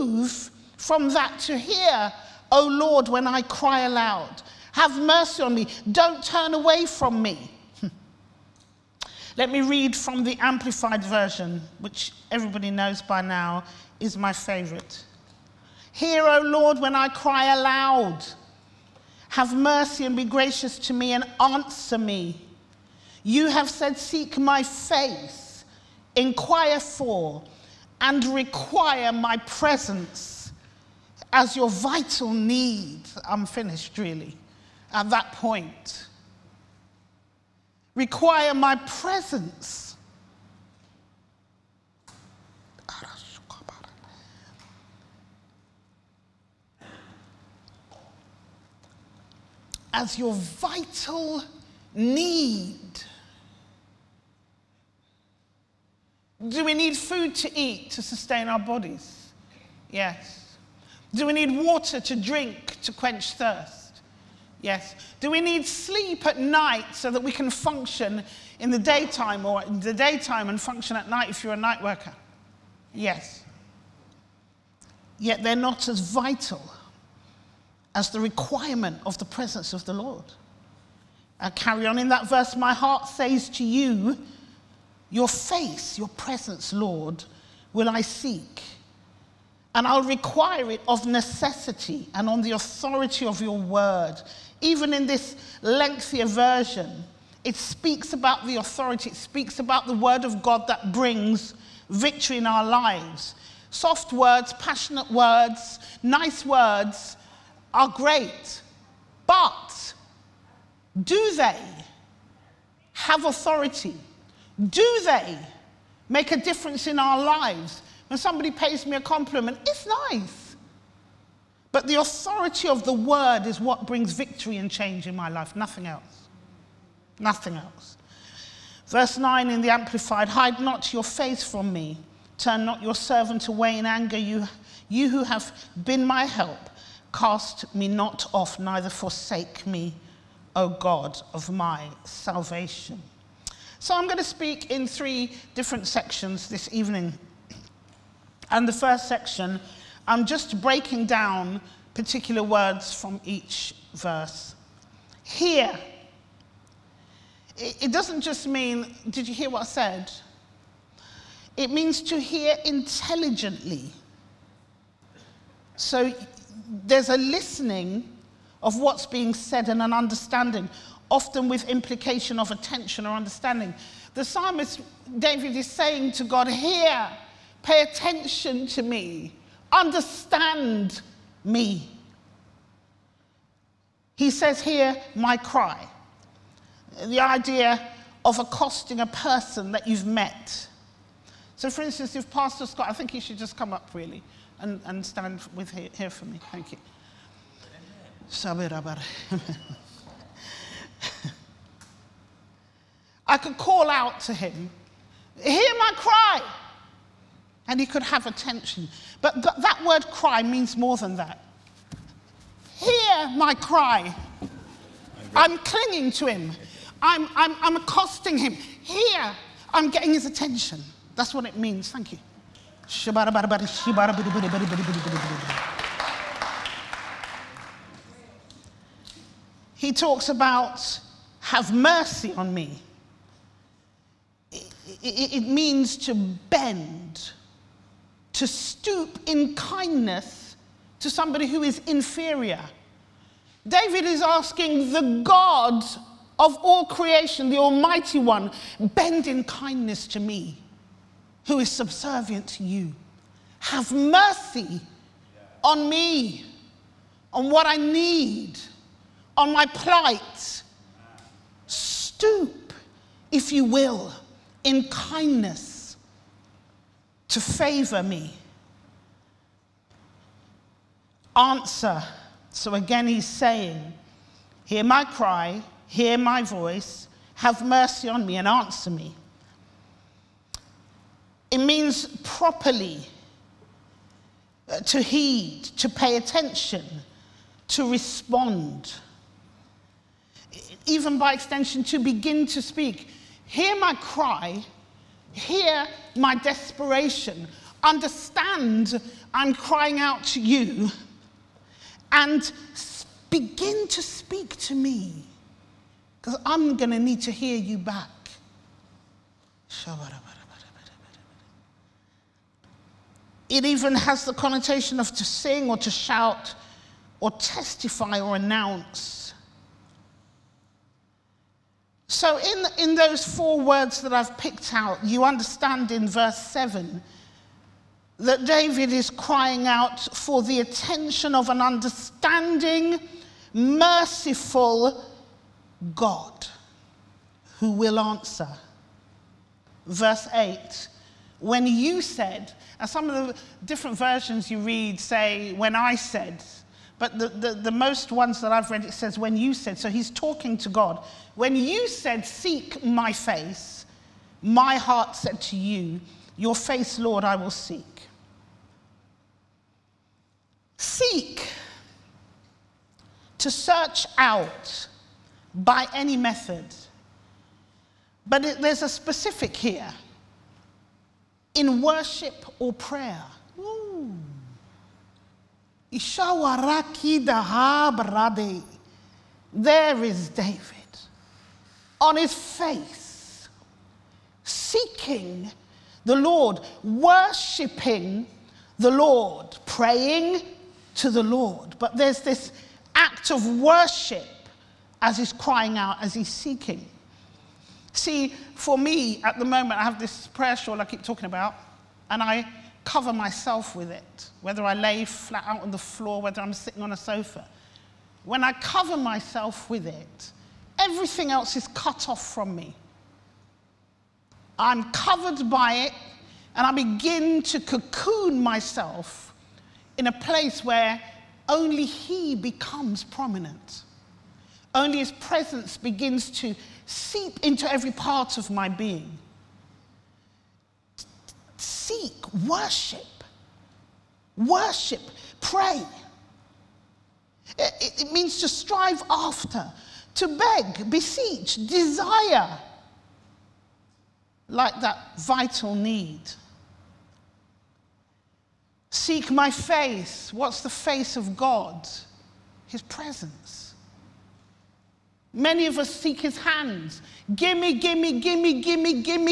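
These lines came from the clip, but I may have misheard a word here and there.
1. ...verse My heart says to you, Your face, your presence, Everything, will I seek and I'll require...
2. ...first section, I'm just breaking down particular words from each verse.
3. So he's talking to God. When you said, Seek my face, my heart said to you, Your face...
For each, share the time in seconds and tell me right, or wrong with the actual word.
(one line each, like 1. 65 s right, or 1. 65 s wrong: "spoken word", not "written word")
1. 82 s wrong: "Lord", not "Everything"
2. 148 s right
3. 349 s right.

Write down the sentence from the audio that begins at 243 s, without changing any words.
David is asking the God of all creation, the Almighty One, bend in kindness to me, who is subservient to you.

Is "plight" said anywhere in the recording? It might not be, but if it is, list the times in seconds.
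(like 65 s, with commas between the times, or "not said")
259 s.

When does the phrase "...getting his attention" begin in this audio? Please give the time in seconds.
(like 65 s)
219 s.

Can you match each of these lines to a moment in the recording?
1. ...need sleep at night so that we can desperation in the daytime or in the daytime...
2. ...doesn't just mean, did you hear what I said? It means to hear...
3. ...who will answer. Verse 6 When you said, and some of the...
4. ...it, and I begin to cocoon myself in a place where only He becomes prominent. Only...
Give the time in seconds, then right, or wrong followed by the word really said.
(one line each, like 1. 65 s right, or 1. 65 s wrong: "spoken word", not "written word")
1. 65 s wrong: "function", not "desperation"
2. 157 s right
3. 337 s wrong: "8", not "6"
4. 415 s right.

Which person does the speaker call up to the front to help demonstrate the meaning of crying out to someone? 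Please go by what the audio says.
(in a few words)
Pastor Scott.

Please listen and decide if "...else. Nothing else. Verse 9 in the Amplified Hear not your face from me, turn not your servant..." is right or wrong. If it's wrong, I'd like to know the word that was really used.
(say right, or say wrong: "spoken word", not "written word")
wrong: "Hide", not "Hear".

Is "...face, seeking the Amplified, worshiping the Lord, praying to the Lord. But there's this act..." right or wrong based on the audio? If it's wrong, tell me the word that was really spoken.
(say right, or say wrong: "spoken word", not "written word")
wrong: "Lord", not "Amplified".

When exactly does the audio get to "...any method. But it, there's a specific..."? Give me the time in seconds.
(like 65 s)
365 s.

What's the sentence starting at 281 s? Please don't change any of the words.
It means properly uh, to heed, to pay attention, to respond.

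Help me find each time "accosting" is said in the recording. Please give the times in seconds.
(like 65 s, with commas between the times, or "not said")
188 s, 217 s.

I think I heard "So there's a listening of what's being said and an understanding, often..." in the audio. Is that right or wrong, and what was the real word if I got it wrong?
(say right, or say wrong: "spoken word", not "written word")
right.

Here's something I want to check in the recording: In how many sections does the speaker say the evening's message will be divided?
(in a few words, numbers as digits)
3.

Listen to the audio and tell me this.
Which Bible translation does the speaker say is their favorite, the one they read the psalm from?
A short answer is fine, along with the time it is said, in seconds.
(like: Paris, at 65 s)
Amplified Version, at 10 s.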